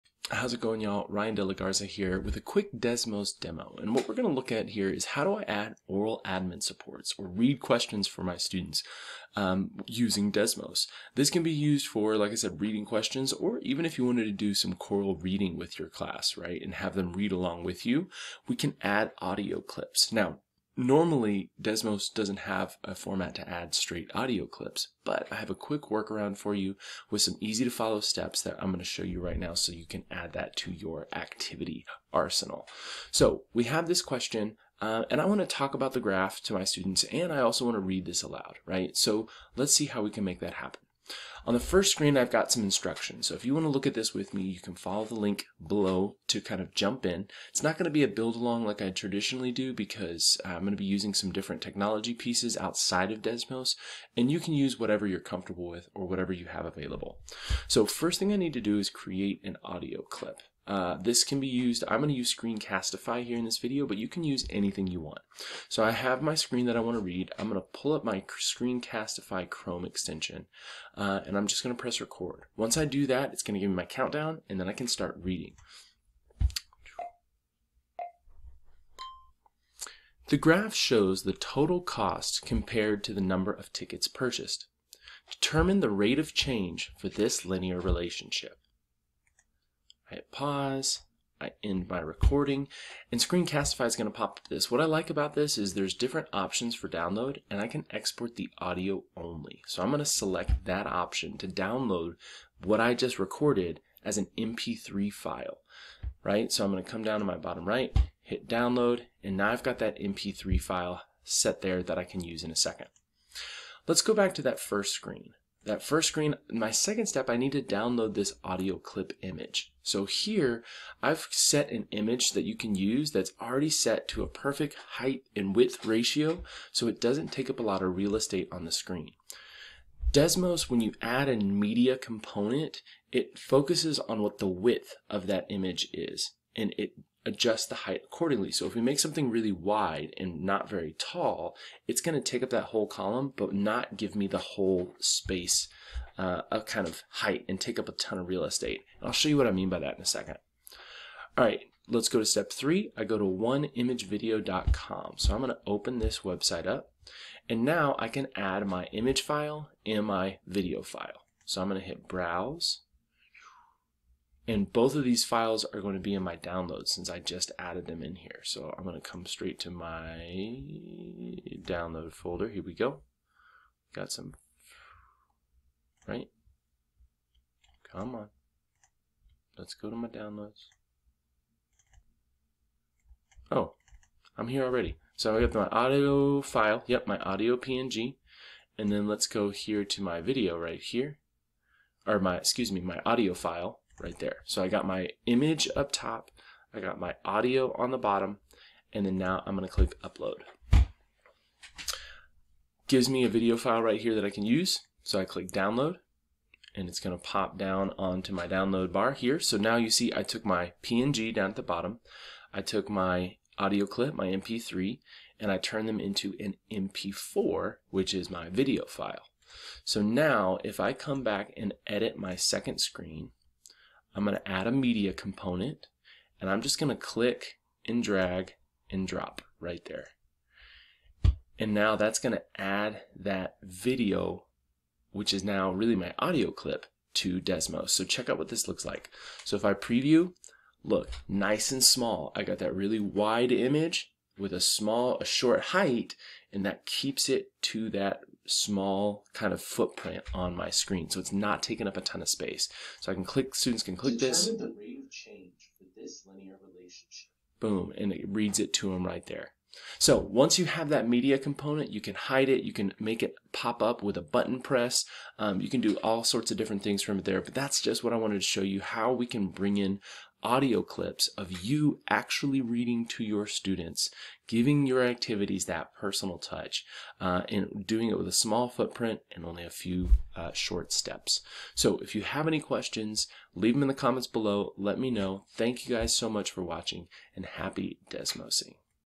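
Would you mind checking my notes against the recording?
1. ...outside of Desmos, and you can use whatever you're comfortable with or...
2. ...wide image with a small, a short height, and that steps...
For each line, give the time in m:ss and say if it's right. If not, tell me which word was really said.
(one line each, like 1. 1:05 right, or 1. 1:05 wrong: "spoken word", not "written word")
1. 0:52 right
2. 4:02 wrong: "keeps", not "steps".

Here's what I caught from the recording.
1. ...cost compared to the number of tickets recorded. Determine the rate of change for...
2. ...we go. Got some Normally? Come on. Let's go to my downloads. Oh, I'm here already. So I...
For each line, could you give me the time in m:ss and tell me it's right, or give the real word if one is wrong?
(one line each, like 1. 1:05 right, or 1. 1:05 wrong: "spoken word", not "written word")
1. 1:21 wrong: "purchased", not "recorded"
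2. 2:52 wrong: "Right", not "Normally".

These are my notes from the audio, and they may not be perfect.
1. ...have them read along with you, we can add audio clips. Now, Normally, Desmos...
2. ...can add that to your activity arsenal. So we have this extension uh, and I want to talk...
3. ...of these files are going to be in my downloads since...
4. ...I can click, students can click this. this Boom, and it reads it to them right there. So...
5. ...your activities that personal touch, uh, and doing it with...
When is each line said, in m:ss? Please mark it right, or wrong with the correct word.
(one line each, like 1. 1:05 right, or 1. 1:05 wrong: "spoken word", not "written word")
1. 0:16 right
2. 0:29 wrong: "question", not "extension"
3. 2:44 right
4. 4:13 right
5. 4:34 right.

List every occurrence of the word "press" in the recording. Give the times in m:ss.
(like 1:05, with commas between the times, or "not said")
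1:11, 4:24.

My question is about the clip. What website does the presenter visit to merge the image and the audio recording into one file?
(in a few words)
oneimagevideo.com.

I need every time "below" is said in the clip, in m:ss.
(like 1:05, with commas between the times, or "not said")
0:45, 4:44.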